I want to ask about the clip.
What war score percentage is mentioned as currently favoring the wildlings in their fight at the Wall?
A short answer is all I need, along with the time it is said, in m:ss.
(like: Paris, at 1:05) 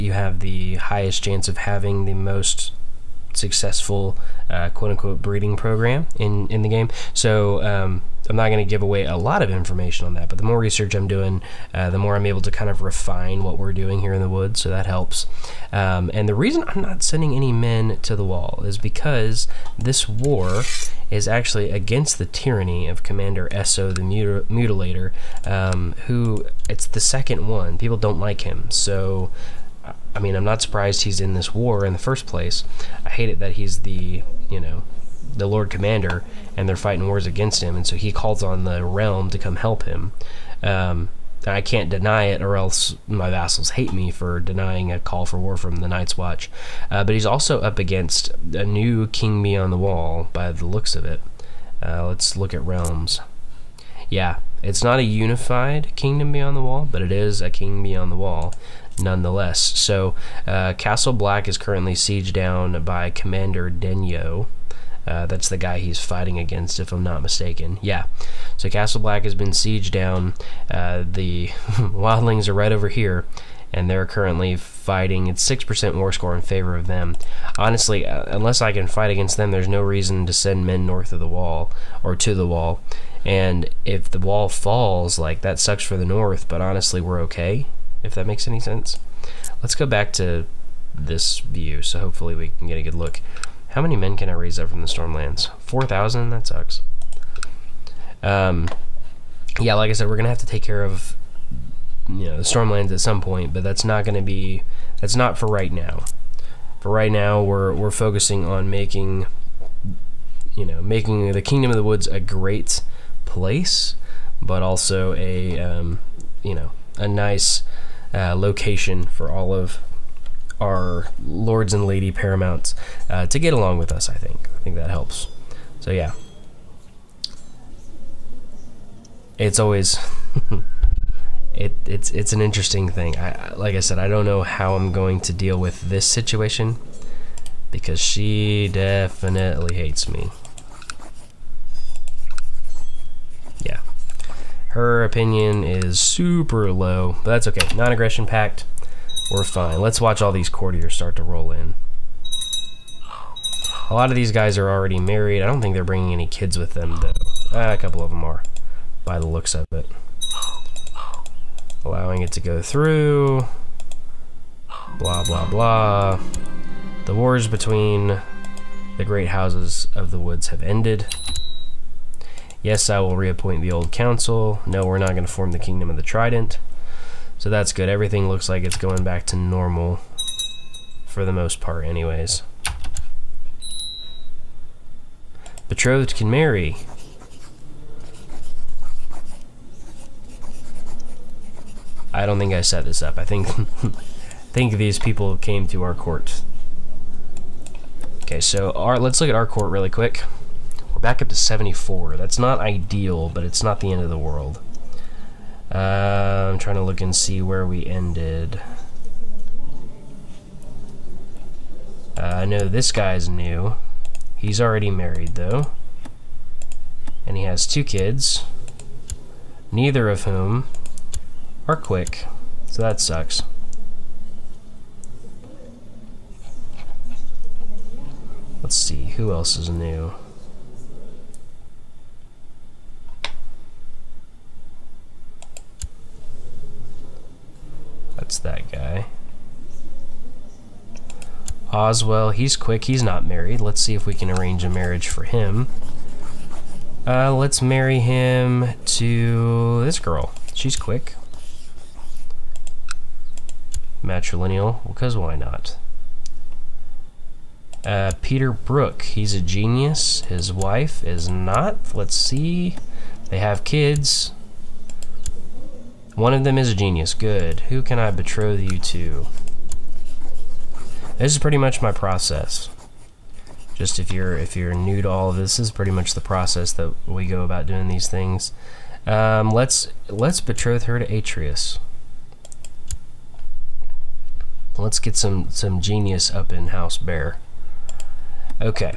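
6%, at 1:15.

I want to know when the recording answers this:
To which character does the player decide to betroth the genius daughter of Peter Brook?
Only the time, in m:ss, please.
4:41.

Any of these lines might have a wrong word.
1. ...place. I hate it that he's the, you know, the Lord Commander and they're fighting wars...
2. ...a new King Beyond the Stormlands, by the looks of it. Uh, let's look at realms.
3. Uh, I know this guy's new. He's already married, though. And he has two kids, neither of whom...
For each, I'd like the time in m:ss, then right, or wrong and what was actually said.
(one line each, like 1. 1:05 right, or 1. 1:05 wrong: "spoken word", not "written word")
1. 0:32 right
2. 0:48 wrong: "Wall", not "Stormlands"
3. 3:32 right.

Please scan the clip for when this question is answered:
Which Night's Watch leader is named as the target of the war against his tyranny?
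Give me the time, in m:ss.
0:23.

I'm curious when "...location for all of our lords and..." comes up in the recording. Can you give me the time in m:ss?
1:58.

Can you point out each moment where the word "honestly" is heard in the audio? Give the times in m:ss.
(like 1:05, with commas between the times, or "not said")
1:17, 1:26.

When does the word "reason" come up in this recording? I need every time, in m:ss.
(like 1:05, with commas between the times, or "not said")
0:16, 1:19.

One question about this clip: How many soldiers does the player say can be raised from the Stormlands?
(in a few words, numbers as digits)
4,000.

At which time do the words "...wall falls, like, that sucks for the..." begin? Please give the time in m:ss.
1:24.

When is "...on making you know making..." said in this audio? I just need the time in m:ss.
1:48.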